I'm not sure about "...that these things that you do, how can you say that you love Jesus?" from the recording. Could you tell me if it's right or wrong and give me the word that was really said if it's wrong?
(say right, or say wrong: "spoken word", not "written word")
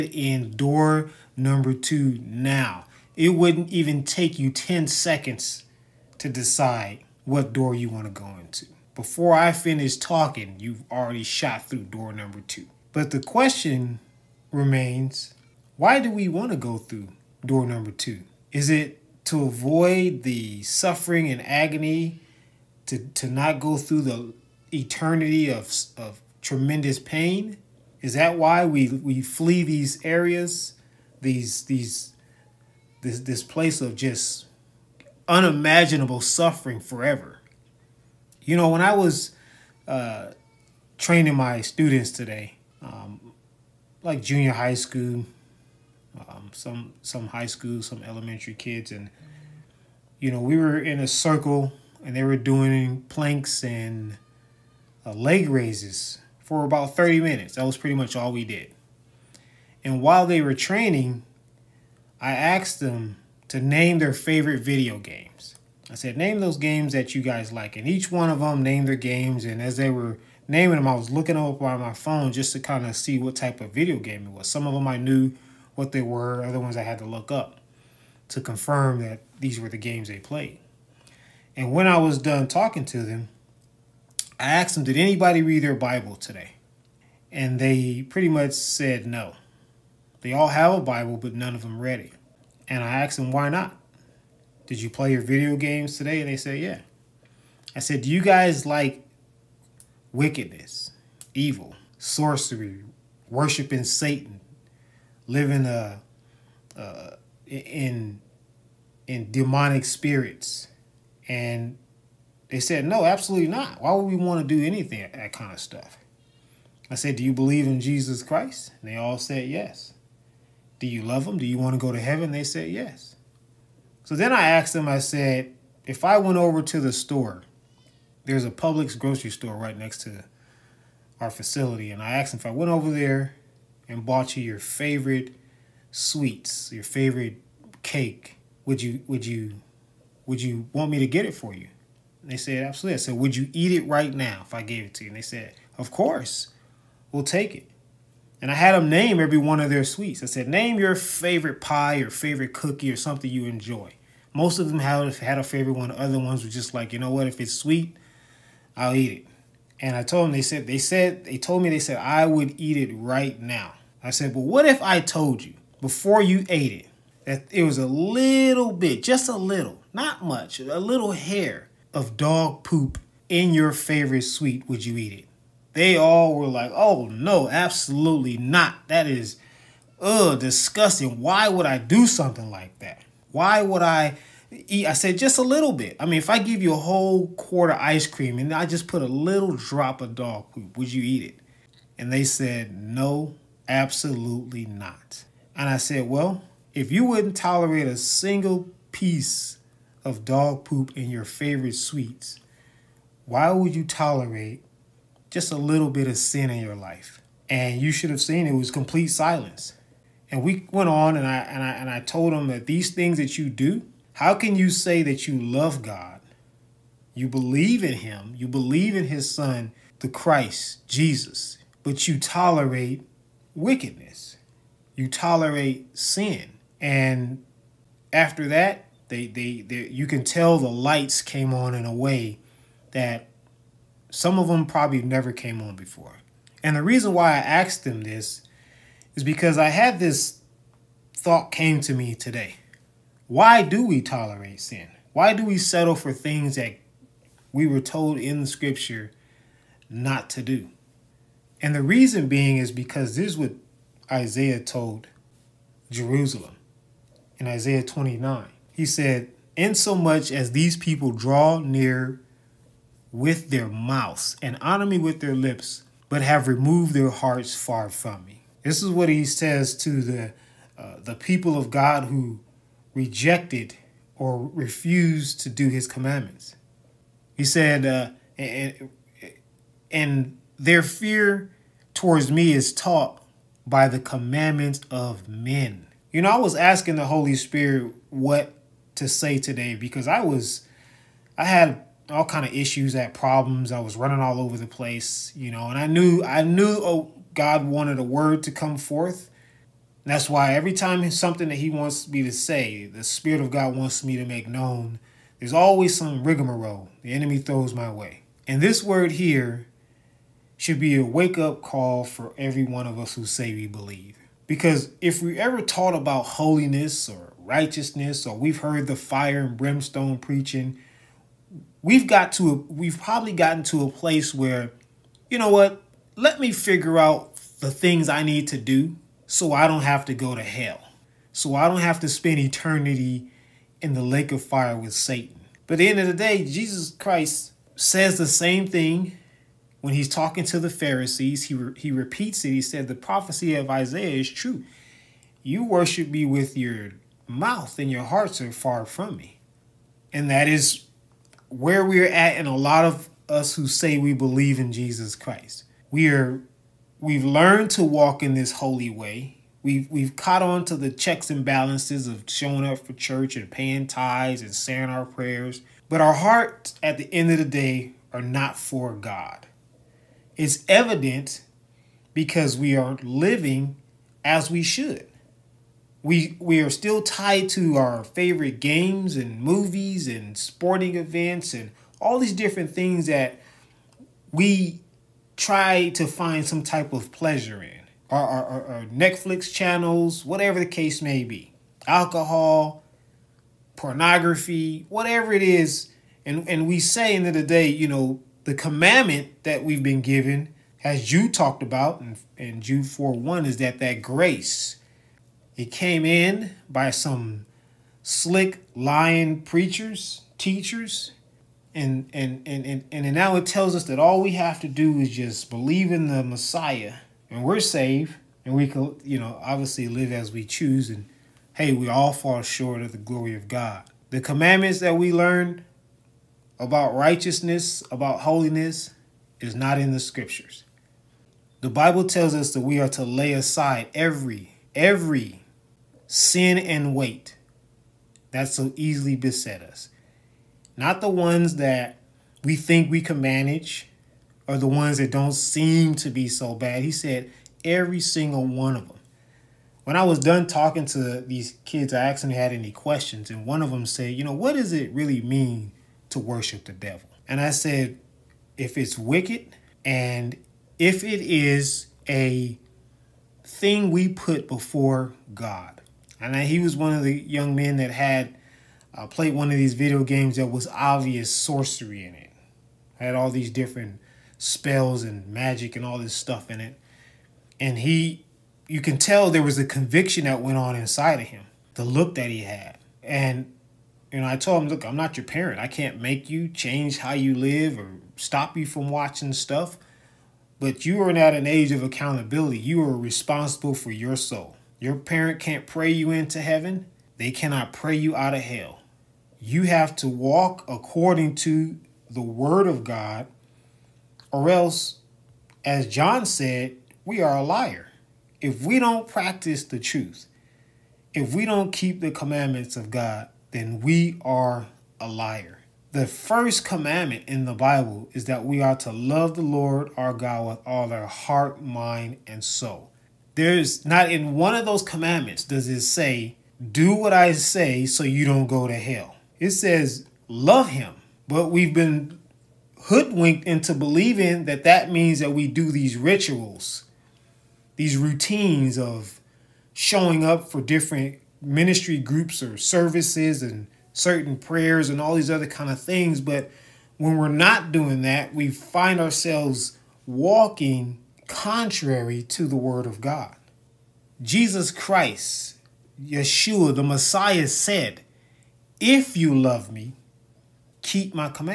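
wrong: "God", not "Jesus".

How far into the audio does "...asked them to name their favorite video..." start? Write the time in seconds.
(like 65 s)
62 s.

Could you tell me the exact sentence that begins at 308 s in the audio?
And this word here should be a wake up call for every one of us who say we believe.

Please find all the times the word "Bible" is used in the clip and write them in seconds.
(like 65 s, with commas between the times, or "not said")
85 s, 90 s, 431 s, 517 s.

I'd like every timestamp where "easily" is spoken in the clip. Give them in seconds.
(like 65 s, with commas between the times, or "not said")
438 s.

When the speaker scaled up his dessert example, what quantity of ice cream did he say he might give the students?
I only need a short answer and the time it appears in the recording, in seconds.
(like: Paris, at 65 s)
A whole quart, at 186 s.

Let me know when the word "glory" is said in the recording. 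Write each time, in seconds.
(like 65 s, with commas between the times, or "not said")
422 s.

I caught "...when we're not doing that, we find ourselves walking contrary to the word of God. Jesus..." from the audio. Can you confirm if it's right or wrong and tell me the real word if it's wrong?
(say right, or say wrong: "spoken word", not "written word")
right.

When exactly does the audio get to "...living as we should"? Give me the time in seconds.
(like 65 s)
373 s.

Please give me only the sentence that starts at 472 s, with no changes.
Had all these different spells and magic and all this stuff in it.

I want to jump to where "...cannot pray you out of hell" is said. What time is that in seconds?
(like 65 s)
497 s.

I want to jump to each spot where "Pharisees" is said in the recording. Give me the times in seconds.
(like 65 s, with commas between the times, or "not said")
340 s.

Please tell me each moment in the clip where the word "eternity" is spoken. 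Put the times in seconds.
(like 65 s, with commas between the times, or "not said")
24 s, 332 s.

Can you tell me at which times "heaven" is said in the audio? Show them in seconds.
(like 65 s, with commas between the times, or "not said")
121 s, 496 s.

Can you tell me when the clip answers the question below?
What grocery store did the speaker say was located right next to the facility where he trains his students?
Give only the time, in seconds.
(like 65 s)
128 s.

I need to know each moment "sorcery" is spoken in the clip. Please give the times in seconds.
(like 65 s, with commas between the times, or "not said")
101 s, 471 s.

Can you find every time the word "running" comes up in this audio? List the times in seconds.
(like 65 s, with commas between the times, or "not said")
293 s.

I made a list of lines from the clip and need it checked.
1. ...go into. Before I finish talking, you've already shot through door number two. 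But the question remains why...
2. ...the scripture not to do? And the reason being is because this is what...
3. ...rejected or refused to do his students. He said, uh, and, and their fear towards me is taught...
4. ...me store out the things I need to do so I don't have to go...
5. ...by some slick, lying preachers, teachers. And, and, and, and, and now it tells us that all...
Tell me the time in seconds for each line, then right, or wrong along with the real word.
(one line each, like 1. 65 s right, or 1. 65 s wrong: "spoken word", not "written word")
1. 8 s right
2. 248 s right
3. 272 s wrong: "commandments", not "students"
4. 326 s wrong: "figure", not "store"
5. 406 s right.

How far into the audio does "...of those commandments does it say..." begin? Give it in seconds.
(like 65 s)
524 s.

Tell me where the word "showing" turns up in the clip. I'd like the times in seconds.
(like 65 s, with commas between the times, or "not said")
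362 s, 539 s.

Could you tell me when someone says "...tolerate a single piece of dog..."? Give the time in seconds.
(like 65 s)
197 s.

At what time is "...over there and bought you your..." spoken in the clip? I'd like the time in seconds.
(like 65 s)
132 s.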